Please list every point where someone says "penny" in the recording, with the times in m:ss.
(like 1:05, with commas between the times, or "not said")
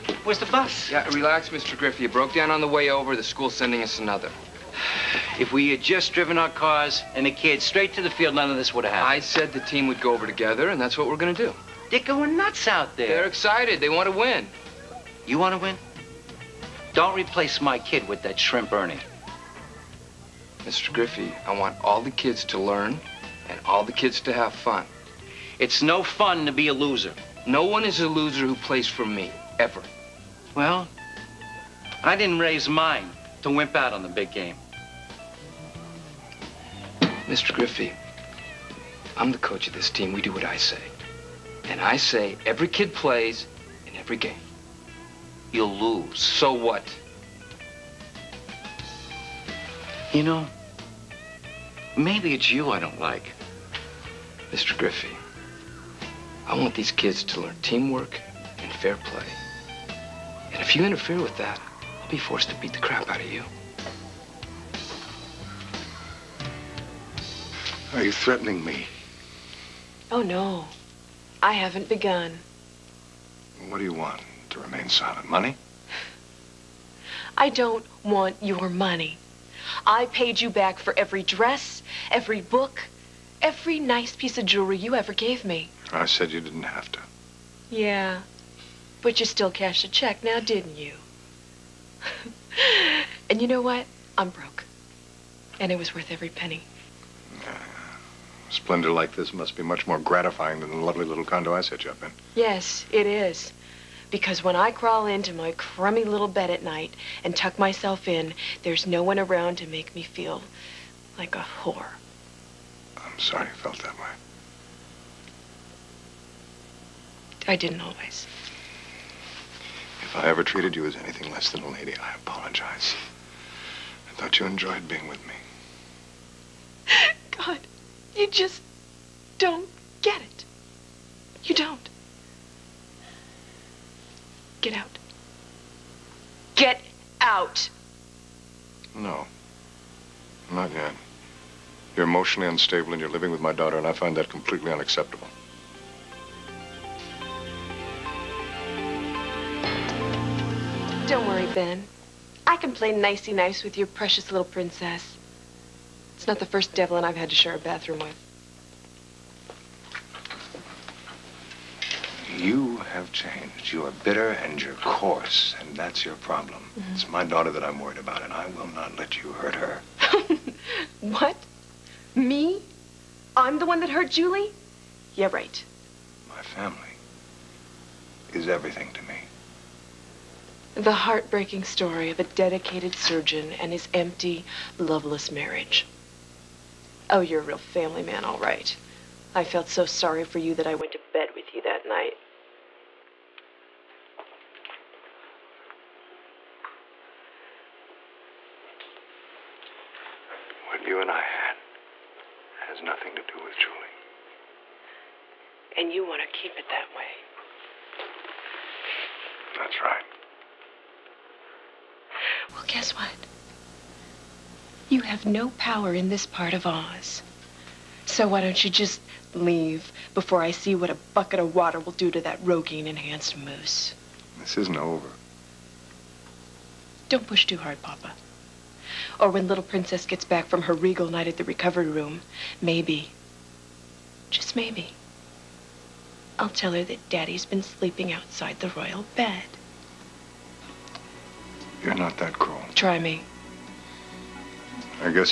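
1:36.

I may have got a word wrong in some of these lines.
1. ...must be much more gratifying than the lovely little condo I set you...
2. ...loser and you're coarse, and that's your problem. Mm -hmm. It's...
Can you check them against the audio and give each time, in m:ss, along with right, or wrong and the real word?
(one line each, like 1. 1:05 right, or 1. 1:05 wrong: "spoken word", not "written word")
1. 1:39 right
2. 2:44 wrong: "bitter", not "loser".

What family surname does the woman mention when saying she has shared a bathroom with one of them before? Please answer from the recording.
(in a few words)
Devlin.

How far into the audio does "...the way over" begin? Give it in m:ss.
0:02.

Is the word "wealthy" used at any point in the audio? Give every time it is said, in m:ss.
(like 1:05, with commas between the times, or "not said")
not said.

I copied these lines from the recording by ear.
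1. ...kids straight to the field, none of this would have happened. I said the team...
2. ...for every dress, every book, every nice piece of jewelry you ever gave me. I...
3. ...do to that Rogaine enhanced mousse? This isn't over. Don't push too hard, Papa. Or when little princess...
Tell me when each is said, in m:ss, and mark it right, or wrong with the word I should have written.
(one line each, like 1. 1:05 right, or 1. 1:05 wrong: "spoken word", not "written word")
1. 0:07 right
2. 1:20 right
3. 3:41 right.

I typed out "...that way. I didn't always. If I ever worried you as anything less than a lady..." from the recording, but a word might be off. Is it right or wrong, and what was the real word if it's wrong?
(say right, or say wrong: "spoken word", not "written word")
wrong: "treated", not "worried".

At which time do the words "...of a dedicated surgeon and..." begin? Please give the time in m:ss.
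3:02.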